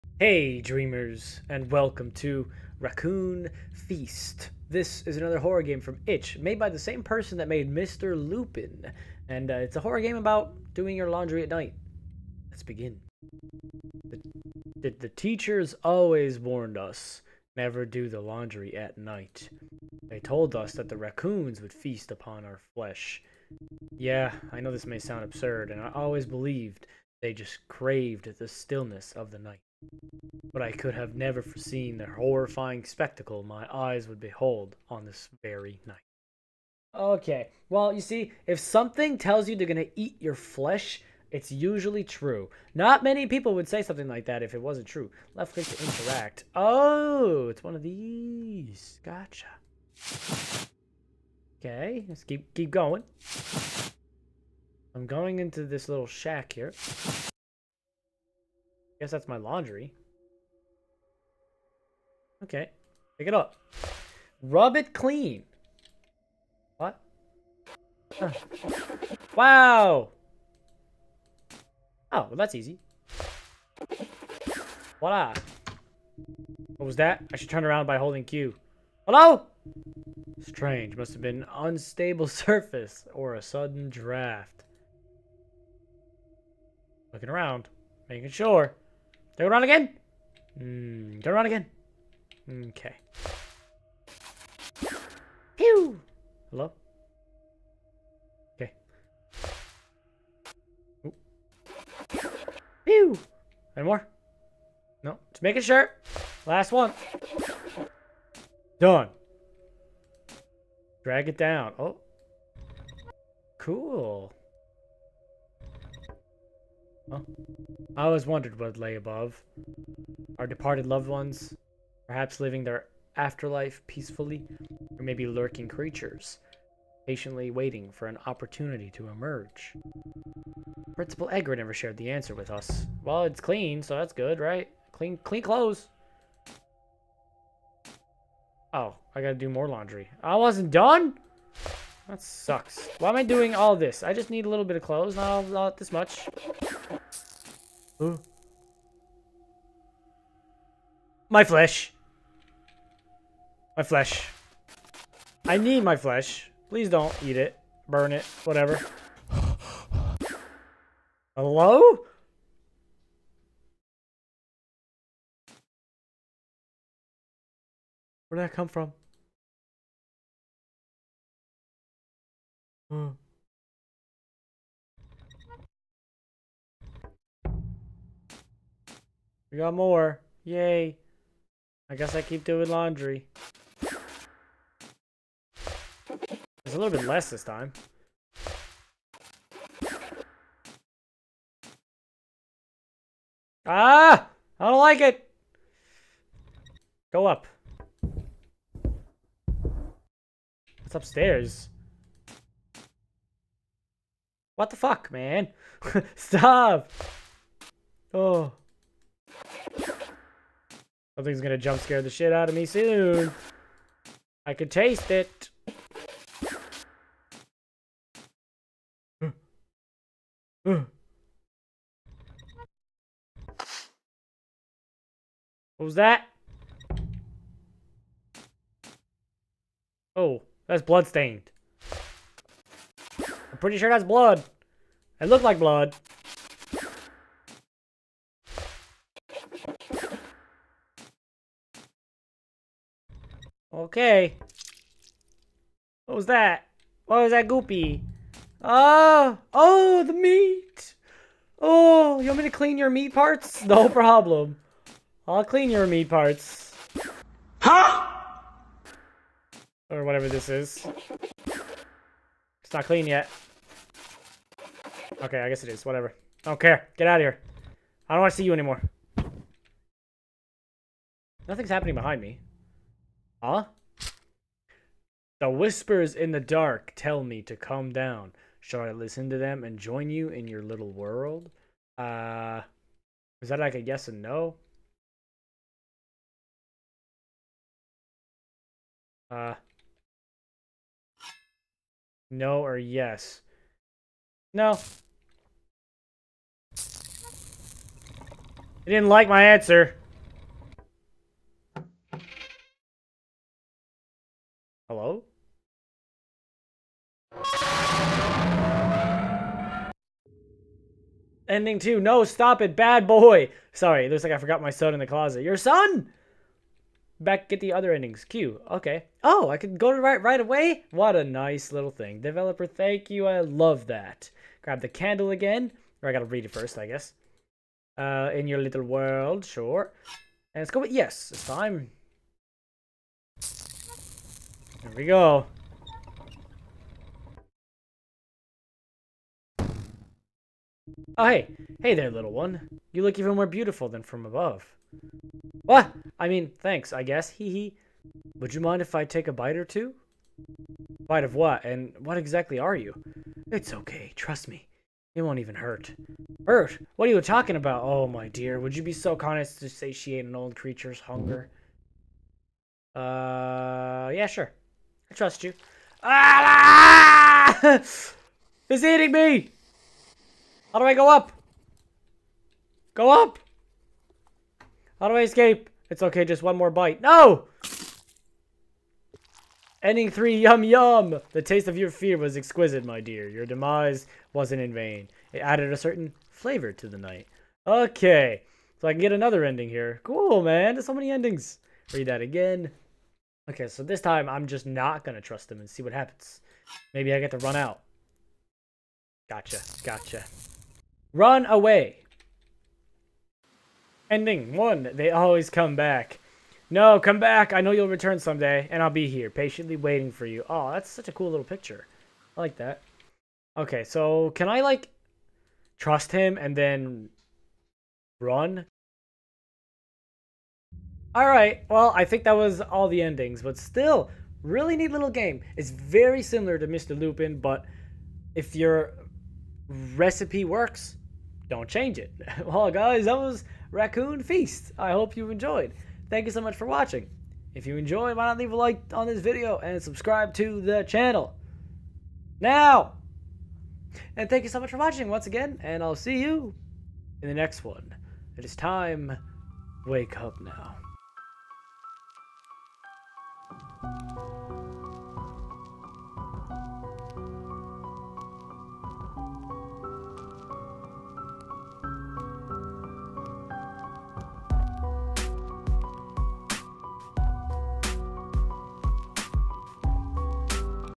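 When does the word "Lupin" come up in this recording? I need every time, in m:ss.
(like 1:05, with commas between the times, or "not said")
0:08, 7:06.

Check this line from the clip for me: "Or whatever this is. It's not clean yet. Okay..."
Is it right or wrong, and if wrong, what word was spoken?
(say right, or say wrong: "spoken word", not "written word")
right.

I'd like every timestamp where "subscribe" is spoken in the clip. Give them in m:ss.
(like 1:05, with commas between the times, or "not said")
7:19.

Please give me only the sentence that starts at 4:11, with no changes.
Oh, you want me to clean your meat parts?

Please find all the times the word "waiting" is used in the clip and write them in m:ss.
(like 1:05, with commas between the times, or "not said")
2:07, 6:49.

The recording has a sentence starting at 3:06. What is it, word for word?
It's a little bit less this time.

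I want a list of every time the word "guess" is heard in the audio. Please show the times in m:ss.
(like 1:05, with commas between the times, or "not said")
0:59, 3:01, 4:25, 5:26, 5:47.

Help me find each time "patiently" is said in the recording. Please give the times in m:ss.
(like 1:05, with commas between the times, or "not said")
2:07, 6:49.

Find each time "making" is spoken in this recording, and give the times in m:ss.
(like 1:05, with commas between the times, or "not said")
1:28, 1:45.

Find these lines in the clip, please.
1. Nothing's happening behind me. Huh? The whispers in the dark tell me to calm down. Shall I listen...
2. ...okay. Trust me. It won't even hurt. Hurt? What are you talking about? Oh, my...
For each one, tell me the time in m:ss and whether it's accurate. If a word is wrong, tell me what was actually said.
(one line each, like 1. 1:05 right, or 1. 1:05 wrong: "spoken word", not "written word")
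1. 4:31 right
2. 5:53 right.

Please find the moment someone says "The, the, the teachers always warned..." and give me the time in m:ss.
0:14.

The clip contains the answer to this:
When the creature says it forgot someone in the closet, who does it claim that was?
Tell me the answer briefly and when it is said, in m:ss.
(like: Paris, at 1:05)
my son, at 5:14.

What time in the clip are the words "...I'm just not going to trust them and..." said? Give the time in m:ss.
6:34.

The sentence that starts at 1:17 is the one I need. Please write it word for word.
I should turn around by holding Q.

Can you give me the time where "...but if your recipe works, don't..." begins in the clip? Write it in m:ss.
7:07.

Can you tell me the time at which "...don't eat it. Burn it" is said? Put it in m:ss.
2:36.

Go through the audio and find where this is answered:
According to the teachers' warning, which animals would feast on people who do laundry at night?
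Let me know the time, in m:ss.
0:20.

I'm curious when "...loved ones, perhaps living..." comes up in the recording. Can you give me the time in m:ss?
2:00.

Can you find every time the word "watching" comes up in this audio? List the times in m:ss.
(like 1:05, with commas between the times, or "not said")
7:16, 7:24.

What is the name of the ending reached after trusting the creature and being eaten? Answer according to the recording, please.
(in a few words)
yum yum.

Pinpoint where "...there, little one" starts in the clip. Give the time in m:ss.
5:41.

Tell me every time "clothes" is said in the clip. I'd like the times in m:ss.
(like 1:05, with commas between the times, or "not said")
2:15, 2:24.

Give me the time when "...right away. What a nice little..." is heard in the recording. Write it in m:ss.
5:20.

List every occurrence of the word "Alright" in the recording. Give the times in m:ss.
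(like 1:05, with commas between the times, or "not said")
7:01.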